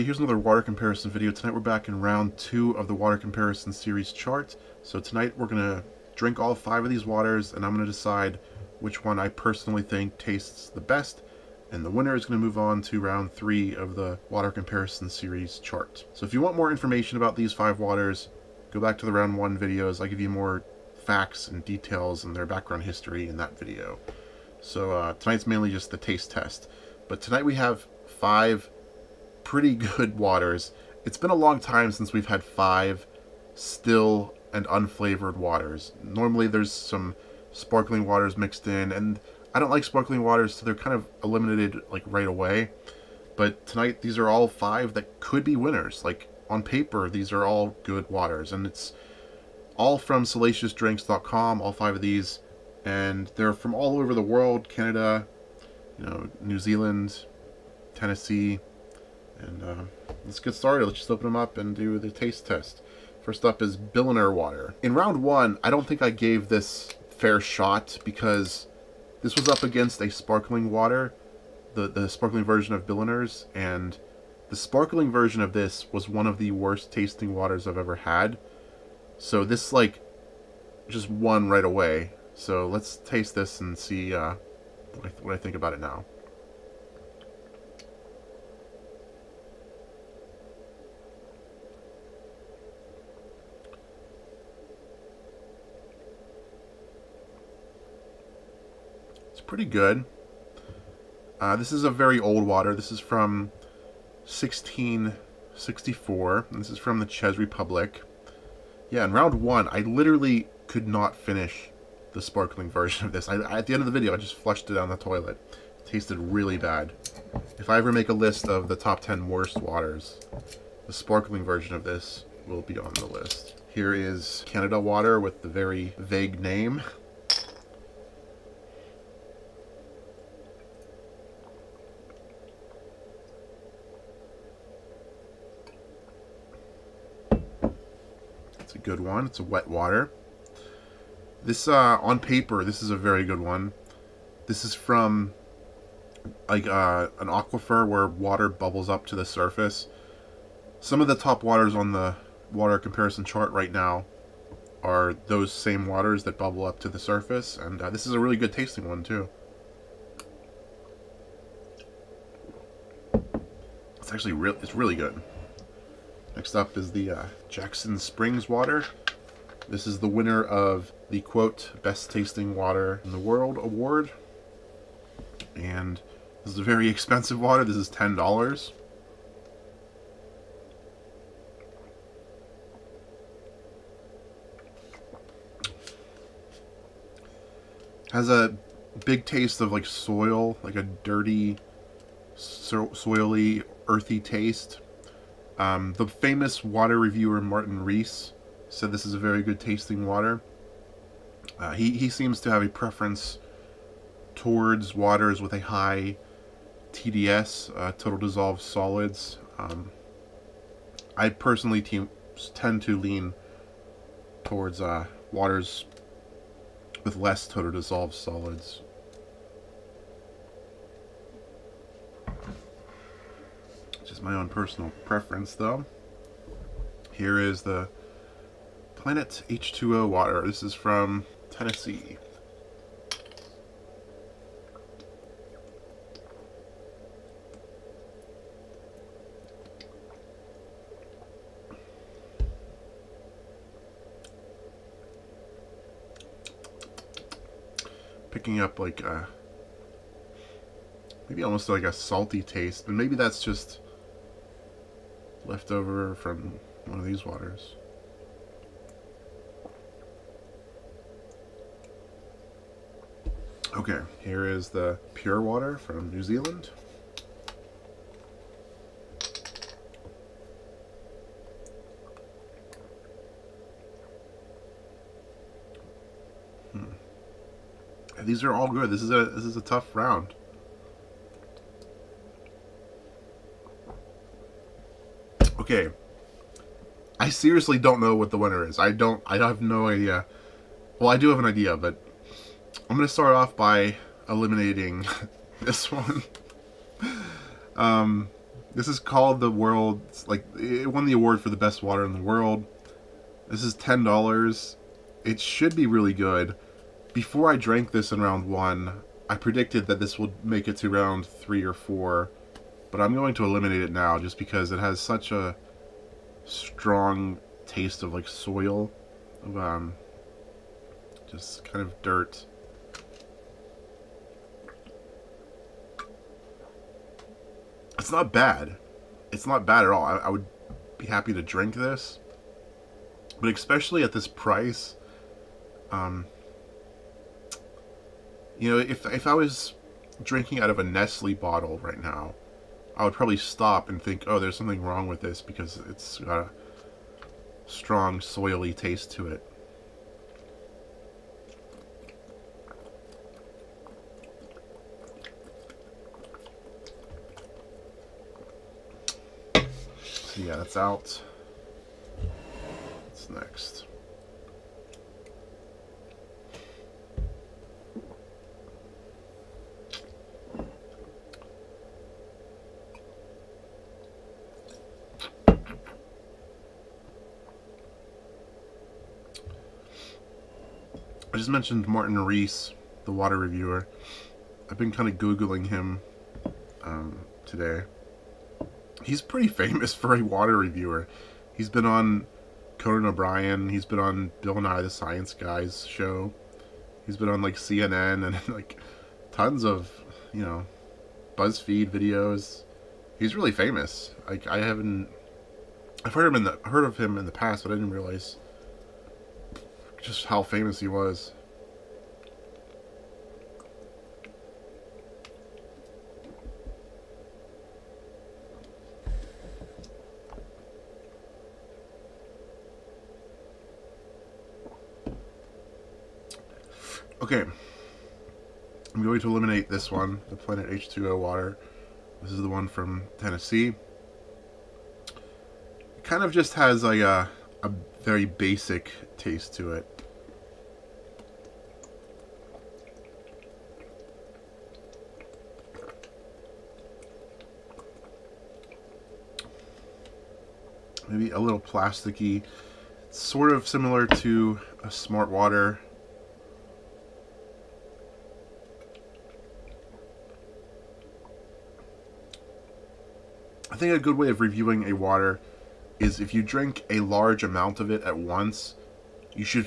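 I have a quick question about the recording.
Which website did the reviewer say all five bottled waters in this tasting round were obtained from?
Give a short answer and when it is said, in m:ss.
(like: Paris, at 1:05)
salaciousdrinks.com, at 0:50.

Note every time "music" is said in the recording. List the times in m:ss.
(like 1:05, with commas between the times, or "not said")
not said.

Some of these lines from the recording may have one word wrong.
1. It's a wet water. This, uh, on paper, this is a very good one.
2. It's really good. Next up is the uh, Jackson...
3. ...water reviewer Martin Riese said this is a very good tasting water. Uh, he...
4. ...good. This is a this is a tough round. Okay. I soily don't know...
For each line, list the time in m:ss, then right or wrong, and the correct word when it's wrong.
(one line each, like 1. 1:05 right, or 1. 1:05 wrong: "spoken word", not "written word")
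1. 2:19 right
2. 2:44 right
3. 3:16 right
4. 4:38 wrong: "seriously", not "soily".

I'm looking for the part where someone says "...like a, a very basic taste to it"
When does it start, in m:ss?
7:16.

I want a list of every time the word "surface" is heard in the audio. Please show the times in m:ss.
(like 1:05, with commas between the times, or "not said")
2:29, 2:36.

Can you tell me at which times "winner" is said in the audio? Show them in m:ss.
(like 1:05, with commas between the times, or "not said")
0:11, 0:45, 2:50, 4:48.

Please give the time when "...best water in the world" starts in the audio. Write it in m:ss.
5:01.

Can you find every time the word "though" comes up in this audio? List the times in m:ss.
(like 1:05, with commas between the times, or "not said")
3:45.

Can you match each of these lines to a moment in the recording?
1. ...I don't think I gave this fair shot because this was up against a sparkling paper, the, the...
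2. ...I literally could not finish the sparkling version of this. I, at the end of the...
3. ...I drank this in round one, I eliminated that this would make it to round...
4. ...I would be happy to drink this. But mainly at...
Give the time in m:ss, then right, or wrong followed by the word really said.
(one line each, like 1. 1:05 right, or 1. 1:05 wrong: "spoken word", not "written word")
1. 1:05 wrong: "water", not "paper"
2. 1:49 right
3. 5:07 wrong: "predicted", not "eliminated"
4. 5:30 wrong: "especially", not "mainly".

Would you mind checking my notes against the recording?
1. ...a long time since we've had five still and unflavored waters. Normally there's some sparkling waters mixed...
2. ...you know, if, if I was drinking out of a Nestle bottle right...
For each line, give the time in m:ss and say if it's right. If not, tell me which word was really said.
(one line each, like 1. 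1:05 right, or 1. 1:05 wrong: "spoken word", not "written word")
1. 0:31 right
2. 5:38 right.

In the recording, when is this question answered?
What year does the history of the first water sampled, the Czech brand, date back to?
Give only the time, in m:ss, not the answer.
1:44.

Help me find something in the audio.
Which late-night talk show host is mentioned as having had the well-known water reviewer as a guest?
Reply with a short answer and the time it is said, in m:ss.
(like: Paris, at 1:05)
Conan O'Brien, at 6:32.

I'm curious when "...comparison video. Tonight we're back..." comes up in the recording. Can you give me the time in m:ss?
0:00.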